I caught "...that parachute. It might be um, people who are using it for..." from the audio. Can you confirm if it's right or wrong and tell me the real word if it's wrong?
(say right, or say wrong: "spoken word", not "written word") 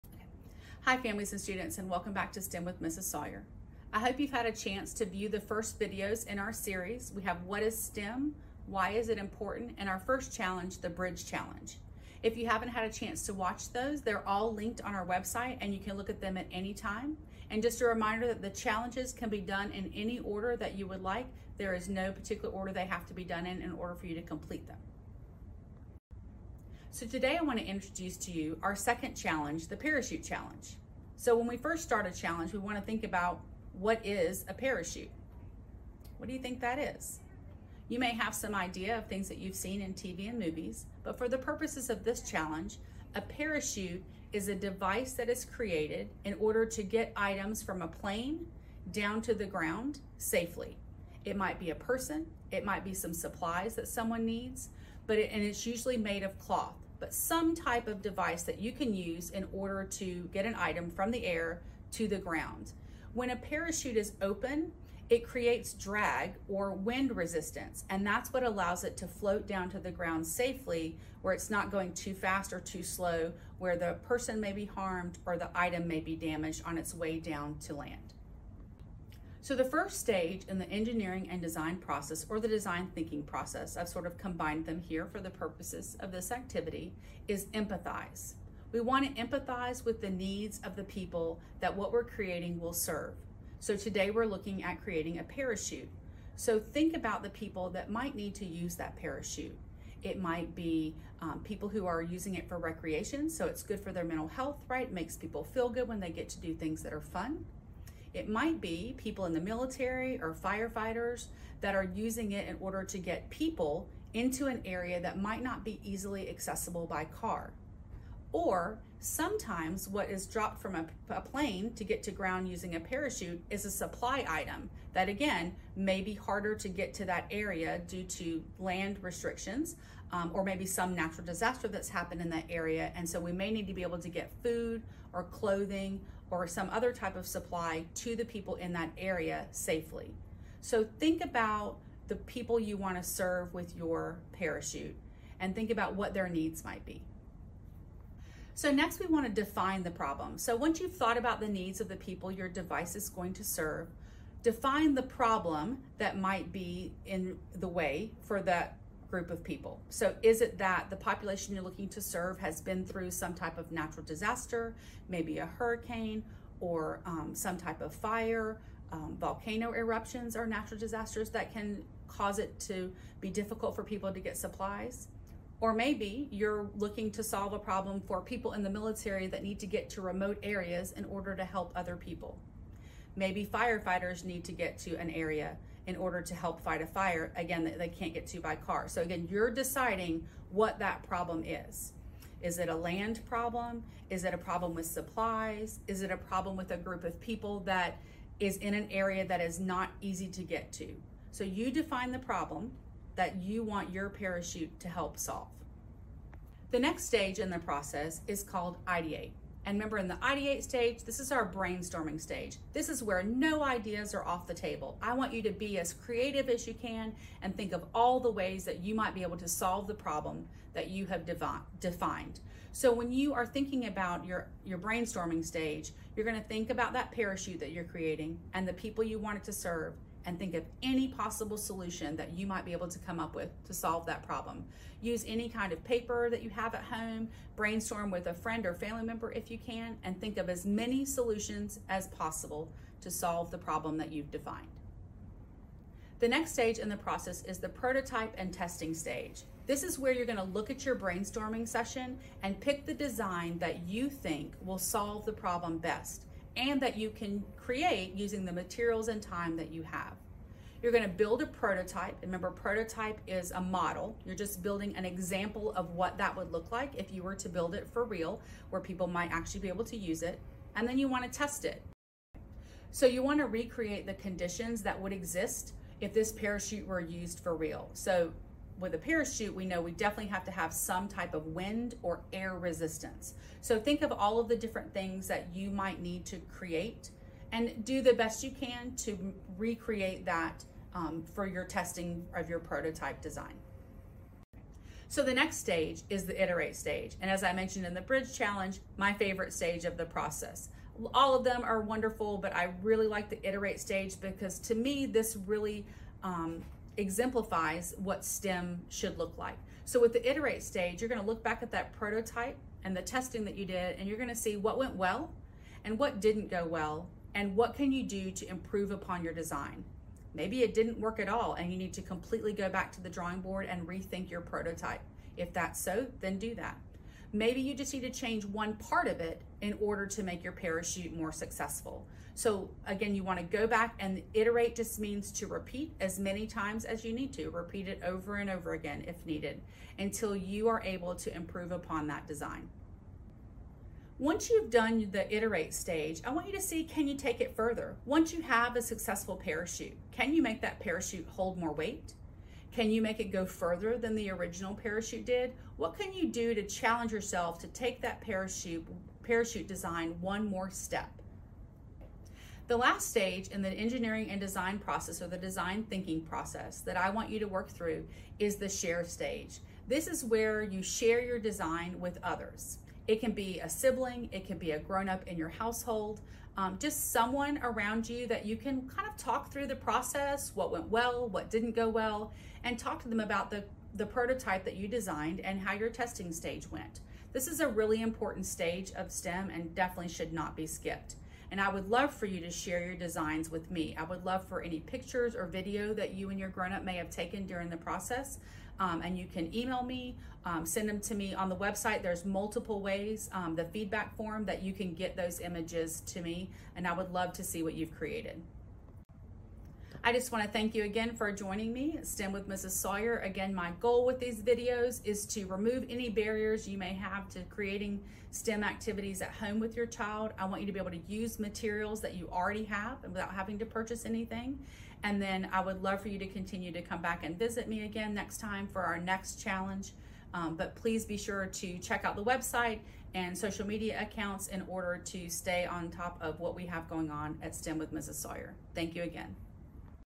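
right.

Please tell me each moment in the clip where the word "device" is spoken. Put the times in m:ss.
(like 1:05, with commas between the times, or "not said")
0:44, 0:58, 2:32.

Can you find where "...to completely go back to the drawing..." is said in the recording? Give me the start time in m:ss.
5:21.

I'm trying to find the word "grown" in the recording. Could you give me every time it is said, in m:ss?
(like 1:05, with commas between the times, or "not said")
6:14, 6:36.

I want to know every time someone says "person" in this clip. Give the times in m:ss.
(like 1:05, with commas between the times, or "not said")
0:51, 1:14.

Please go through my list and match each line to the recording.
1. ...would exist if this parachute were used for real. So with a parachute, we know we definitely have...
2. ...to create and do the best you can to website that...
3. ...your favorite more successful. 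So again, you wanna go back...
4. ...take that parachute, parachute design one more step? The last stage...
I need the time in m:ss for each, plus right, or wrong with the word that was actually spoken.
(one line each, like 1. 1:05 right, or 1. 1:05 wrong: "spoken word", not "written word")
1. 4:34 right
2. 4:46 wrong: "recreate", not "website"
3. 5:30 wrong: "parachute", not "favorite"
4. 5:57 right.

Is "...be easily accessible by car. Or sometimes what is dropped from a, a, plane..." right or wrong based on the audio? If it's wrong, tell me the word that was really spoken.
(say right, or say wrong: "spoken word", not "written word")
right.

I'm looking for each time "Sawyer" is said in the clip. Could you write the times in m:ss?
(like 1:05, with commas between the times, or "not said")
0:03, 6:52, 7:18.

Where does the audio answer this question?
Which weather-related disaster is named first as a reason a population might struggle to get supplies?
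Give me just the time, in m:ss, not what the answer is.
2:45.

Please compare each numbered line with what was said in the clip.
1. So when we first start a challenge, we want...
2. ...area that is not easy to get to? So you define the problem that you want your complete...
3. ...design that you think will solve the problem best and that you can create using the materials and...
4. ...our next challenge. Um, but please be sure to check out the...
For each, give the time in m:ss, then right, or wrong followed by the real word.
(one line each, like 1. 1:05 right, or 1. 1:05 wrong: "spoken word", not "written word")
1. 0:31 right
2. 3:18 wrong: "parachute", not "complete"
3. 4:12 right
4. 7:08 right.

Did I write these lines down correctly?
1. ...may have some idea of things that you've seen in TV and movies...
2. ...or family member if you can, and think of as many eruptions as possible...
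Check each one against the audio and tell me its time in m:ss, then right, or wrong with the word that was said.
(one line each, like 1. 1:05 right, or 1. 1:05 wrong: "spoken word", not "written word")
1. 0:37 right
2. 3:58 wrong: "solutions", not "eruptions".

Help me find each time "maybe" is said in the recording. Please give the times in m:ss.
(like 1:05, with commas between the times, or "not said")
2:10, 2:45, 2:55, 3:03, 5:20, 5:27.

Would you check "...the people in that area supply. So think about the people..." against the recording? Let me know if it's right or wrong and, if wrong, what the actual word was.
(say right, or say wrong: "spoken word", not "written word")
wrong: "safely", not "supply".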